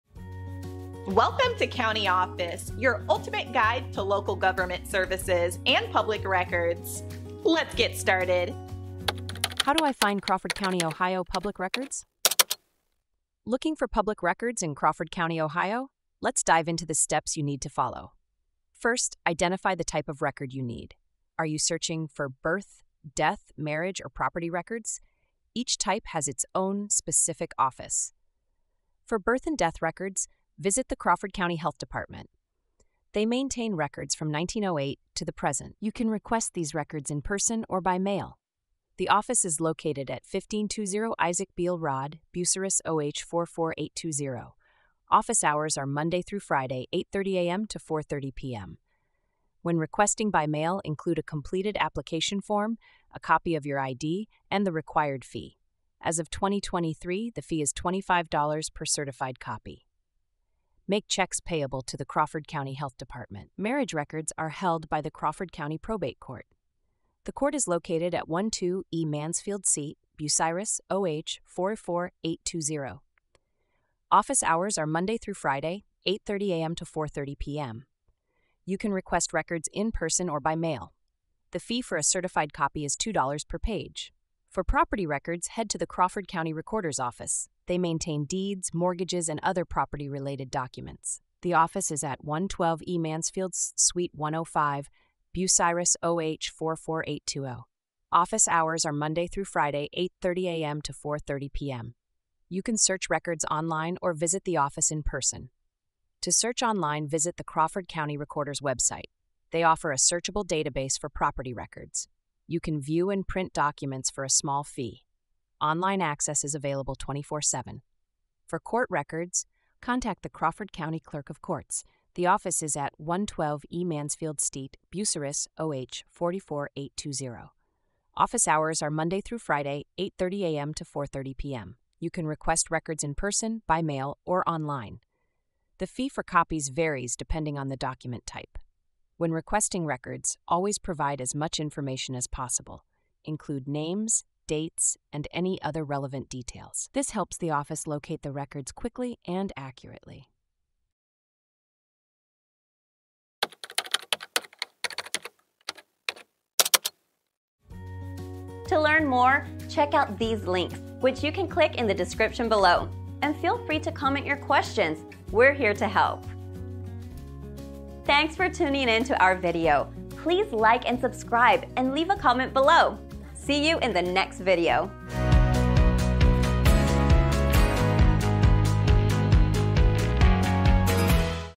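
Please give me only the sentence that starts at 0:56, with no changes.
As of 2023, the fee is $25 per certified copy make checks payable to the Crawford County Health Department.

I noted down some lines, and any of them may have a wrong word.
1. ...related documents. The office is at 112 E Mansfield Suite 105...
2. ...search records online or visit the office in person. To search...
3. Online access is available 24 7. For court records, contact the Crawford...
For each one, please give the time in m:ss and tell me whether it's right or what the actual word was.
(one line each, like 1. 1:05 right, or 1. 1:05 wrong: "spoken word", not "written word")
1. 1:30 right
2. 1:42 right
3. 1:55 right.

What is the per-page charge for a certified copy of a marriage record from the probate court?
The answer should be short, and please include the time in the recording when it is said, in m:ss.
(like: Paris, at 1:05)
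$2, at 1:22.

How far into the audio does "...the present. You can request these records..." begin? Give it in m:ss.
0:35.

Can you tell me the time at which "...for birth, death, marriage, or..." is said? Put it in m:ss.
0:22.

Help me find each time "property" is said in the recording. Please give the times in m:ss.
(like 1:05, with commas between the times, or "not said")
0:24, 1:24, 1:29, 1:51.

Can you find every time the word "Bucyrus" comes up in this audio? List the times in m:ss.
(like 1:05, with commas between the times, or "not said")
0:42, 1:10, 1:35, 2:04.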